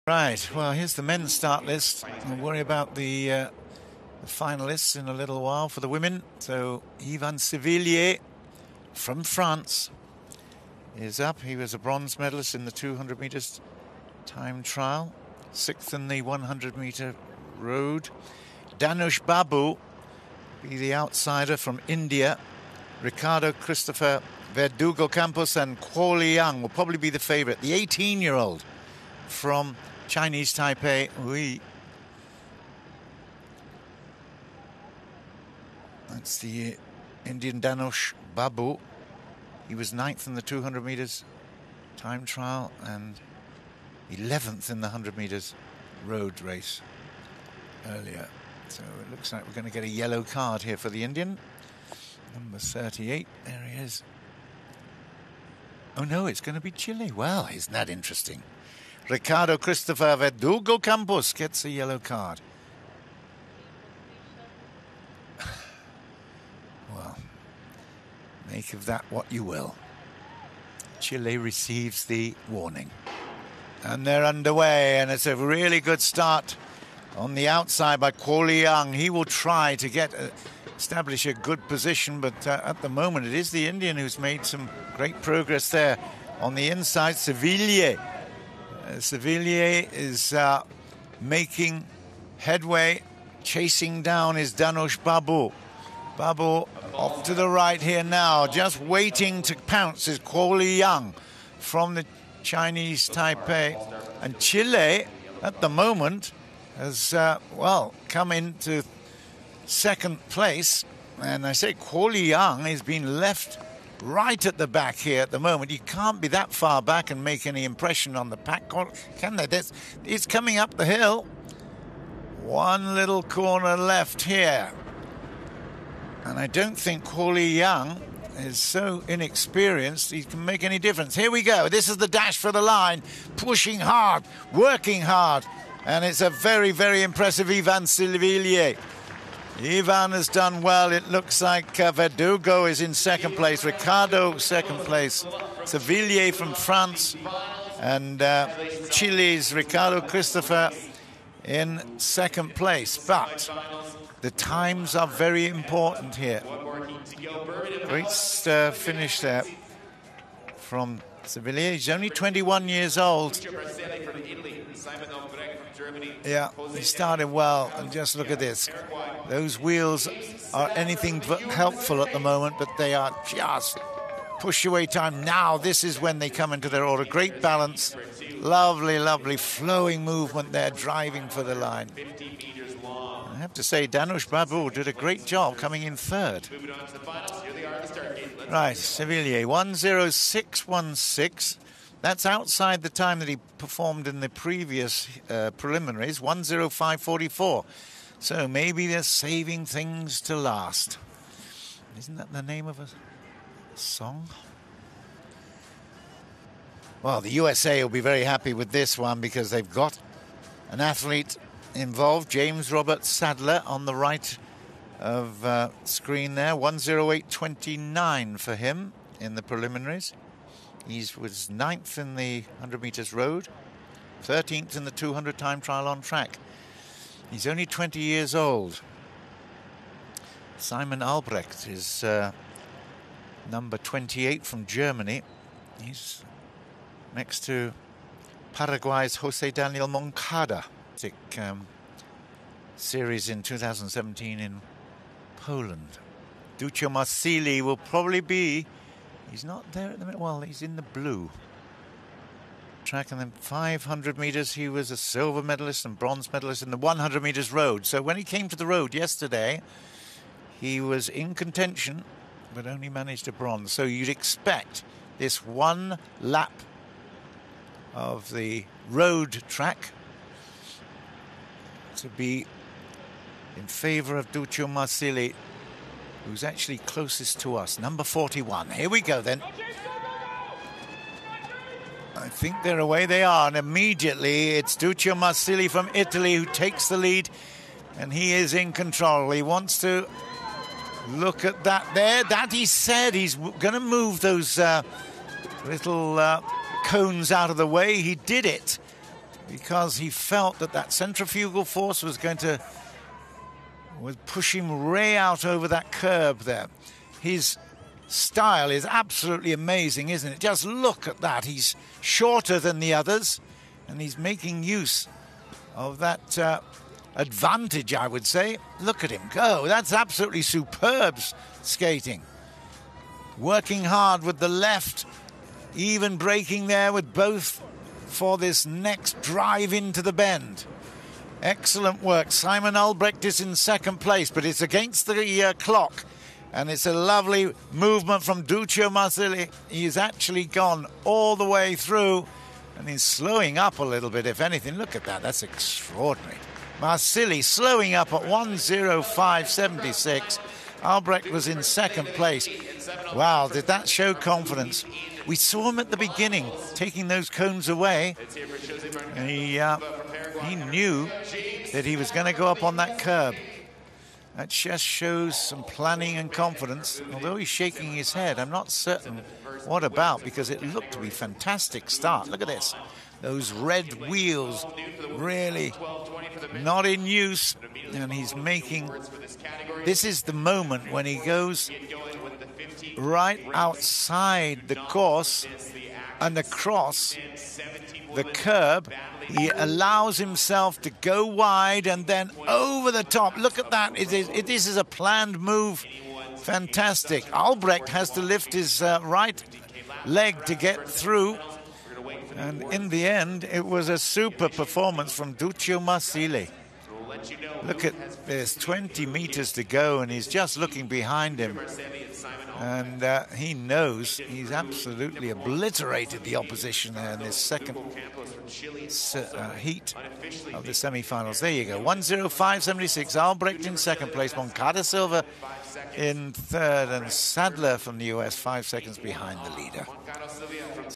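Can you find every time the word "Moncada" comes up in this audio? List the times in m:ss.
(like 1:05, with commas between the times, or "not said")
3:59, 7:04.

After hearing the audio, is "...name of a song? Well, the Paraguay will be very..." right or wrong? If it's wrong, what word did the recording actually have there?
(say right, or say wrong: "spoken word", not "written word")
wrong: "USA", not "Paraguay".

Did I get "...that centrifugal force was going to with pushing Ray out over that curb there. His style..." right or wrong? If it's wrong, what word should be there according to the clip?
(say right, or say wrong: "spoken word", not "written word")
right.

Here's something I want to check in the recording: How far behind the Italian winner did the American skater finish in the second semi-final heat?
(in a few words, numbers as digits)
5 seconds.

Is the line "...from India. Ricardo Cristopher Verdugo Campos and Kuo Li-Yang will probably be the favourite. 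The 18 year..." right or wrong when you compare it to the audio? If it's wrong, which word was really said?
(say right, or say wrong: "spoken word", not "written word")
right.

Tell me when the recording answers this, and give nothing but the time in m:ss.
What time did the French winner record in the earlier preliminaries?
3:16.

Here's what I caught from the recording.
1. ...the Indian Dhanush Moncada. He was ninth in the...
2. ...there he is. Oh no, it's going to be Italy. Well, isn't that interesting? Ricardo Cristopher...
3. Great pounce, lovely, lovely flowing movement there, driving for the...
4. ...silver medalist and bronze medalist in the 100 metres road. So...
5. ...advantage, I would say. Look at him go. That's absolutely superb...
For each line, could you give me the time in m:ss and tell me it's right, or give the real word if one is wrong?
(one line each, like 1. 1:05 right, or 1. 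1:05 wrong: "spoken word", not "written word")
1. 0:36 wrong: "Babu", not "Moncada"
2. 0:53 wrong: "Chile", not "Italy"
3. 2:57 wrong: "balance", not "pounce"
4. 4:14 right
5. 5:17 right.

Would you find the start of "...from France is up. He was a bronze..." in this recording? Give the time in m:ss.
0:08.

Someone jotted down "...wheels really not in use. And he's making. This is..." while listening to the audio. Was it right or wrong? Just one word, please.
right.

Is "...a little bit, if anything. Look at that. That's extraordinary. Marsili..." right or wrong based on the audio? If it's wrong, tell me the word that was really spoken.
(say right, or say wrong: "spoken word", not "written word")
right.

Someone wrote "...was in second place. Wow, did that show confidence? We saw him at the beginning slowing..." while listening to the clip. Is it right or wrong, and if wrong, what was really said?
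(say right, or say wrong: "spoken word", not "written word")
wrong: "taking", not "slowing".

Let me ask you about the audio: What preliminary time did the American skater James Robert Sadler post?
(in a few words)
108.29.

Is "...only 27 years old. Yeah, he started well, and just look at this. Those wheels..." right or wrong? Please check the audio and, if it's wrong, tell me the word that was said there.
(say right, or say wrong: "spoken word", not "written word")
wrong: "21", not "27".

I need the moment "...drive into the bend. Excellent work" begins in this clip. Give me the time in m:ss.
5:29.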